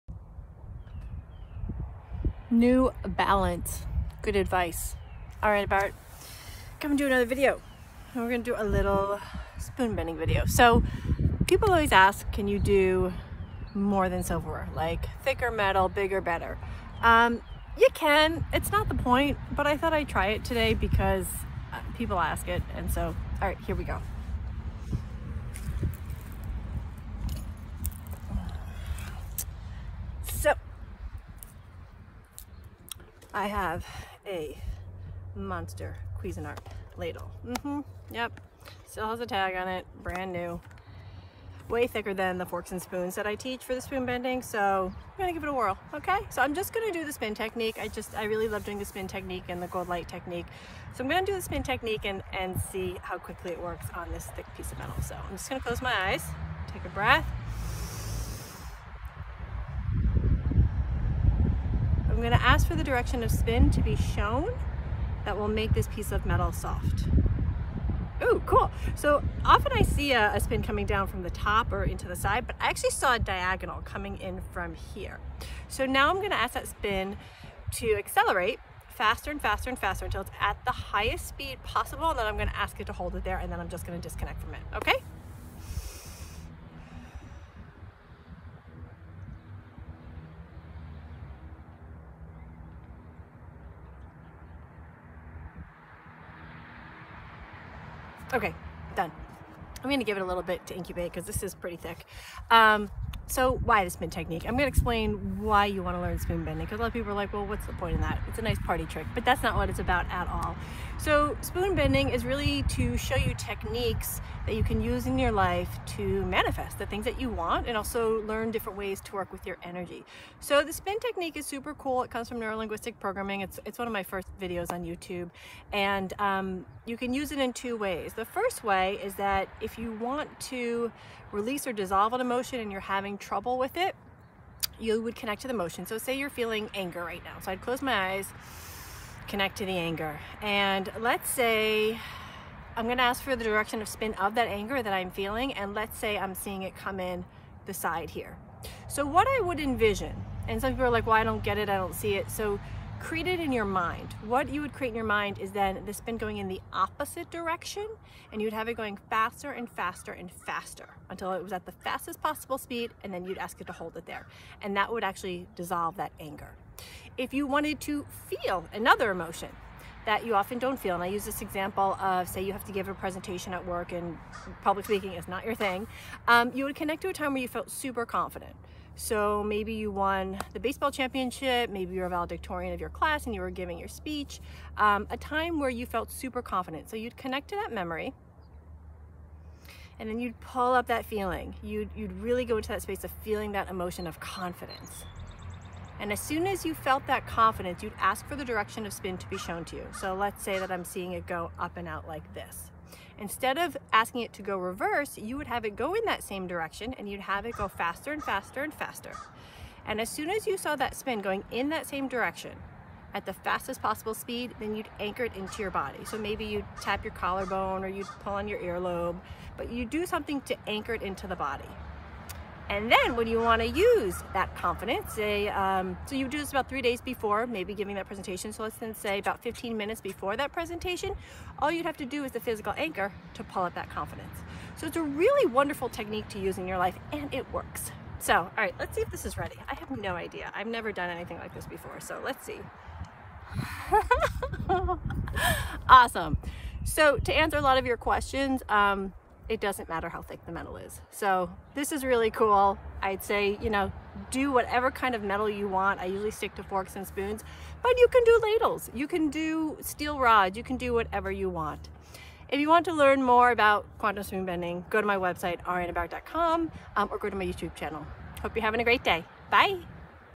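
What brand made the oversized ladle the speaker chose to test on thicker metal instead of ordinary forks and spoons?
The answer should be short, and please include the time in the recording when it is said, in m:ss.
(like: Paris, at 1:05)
Cuisinart, at 0:36.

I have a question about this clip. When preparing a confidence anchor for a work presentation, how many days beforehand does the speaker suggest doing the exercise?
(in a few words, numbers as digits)
3 days.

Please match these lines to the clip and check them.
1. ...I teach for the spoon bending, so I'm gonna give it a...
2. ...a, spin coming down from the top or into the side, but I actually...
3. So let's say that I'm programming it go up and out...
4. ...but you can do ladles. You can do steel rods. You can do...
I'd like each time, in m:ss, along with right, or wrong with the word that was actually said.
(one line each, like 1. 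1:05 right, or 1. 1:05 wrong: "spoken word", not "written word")
1. 0:43 right
2. 1:10 right
3. 3:19 wrong: "seeing", not "programming"
4. 4:17 right.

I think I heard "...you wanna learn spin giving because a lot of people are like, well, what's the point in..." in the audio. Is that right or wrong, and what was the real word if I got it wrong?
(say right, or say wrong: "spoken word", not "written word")
wrong: "bending", not "giving".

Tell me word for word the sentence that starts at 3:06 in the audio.
So you'd connect to that memory and then you'd pull up that feeling.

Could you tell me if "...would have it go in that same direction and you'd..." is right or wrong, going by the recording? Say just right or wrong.
right.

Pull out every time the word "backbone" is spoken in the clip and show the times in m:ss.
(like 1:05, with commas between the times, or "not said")
not said.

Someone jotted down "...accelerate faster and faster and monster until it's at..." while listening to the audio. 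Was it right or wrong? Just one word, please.
wrong.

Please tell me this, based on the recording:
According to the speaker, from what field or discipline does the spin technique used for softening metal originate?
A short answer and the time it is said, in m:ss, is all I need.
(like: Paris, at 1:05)
Neurolinguistic programming, at 2:02.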